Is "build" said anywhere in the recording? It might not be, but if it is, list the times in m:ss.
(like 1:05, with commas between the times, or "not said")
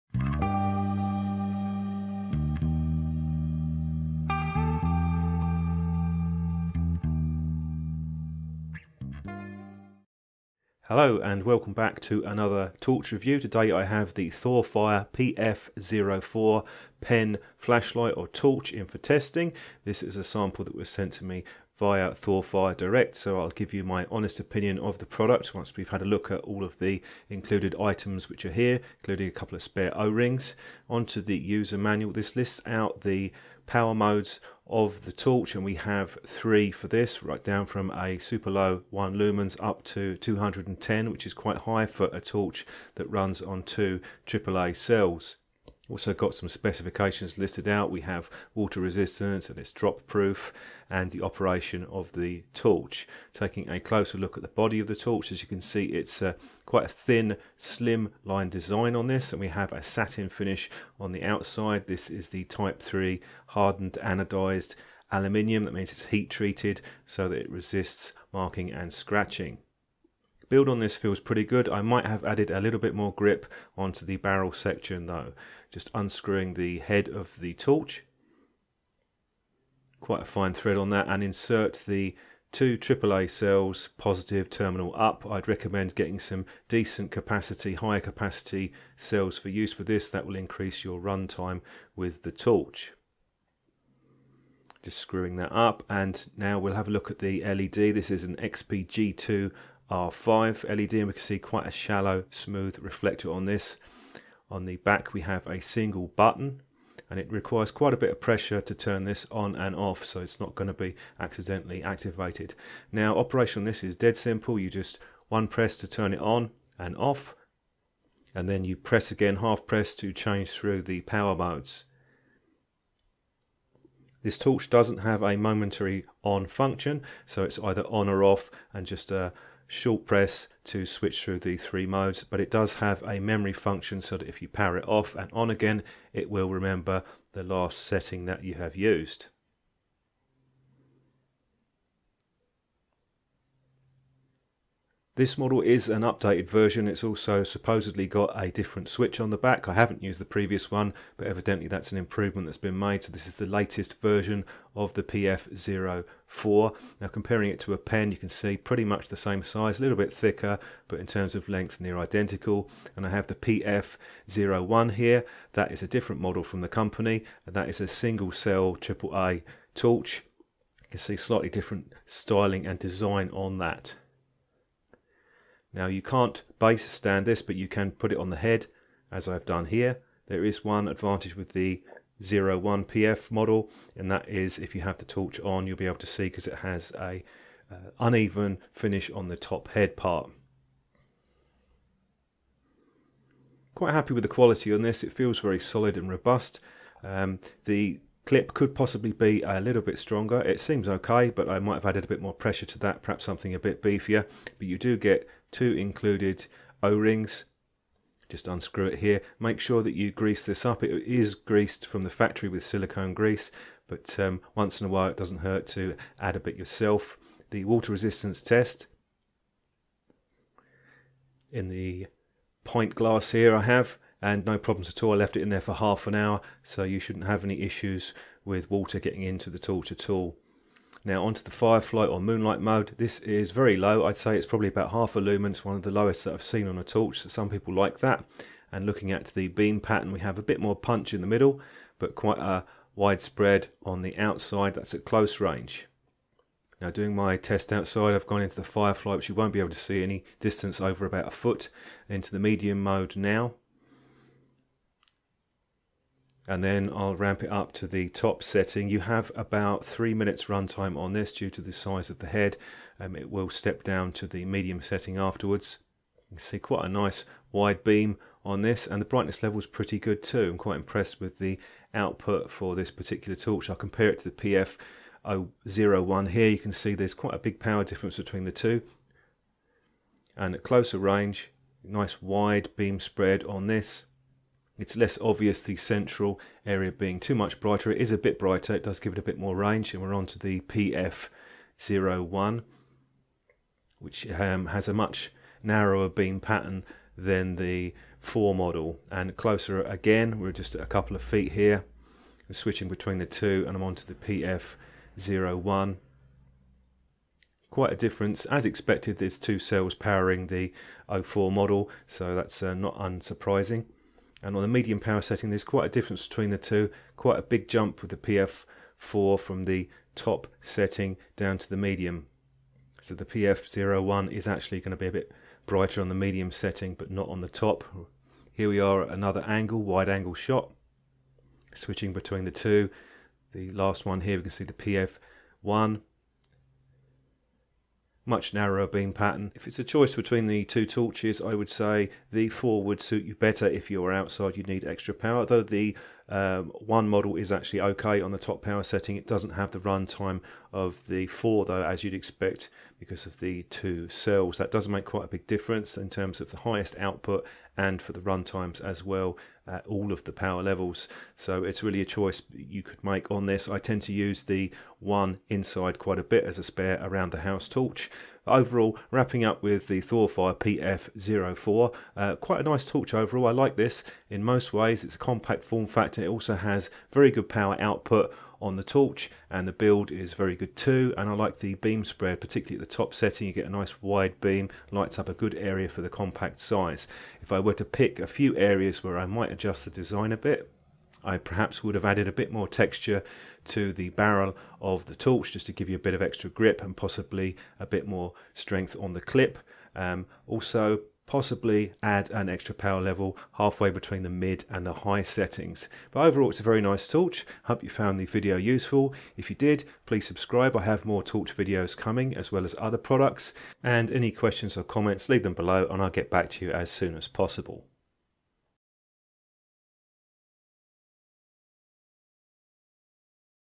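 1:10, 6:19.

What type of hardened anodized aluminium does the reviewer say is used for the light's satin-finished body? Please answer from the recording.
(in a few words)
Type 3.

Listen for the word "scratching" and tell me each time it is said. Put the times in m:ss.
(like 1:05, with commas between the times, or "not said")
1:08.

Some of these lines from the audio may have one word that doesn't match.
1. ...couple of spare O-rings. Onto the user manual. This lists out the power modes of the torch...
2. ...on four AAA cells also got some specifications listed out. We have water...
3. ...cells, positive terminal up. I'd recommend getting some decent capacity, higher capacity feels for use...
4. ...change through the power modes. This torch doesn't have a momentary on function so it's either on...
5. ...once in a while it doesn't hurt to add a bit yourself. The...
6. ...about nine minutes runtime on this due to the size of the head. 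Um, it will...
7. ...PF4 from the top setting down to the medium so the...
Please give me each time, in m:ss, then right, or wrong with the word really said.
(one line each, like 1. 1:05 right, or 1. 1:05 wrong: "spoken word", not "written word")
1. 0:29 right
2. 0:43 wrong: "two", not "four"
3. 1:23 wrong: "cells", not "feels"
4. 2:00 right
5. 3:34 right
6. 4:19 wrong: "three", not "nine"
7. 5:18 right.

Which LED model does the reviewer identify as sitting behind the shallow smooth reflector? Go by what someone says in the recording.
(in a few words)
XPG2 R5.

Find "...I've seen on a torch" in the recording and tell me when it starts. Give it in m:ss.
3:56.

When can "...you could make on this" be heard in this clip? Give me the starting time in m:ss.
6:02.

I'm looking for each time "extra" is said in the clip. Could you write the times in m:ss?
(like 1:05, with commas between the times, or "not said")
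5:44, 6:36, 6:42.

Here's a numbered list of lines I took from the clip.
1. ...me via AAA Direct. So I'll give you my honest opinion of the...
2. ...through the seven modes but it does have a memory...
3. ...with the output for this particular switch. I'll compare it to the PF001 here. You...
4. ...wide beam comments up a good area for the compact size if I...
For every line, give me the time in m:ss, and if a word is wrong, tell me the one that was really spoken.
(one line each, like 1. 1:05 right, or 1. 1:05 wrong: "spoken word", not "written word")
1. 0:21 wrong: "Thorfire", not "AAA"
2. 2:11 wrong: "three", not "seven"
3. 4:31 wrong: "torch", not "switch"
4. 6:24 wrong: "lights", not "comments".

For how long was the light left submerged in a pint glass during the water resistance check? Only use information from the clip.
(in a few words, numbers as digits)
half an hour.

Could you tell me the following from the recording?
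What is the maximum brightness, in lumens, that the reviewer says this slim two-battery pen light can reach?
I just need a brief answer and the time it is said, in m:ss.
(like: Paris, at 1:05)
210, at 0:40.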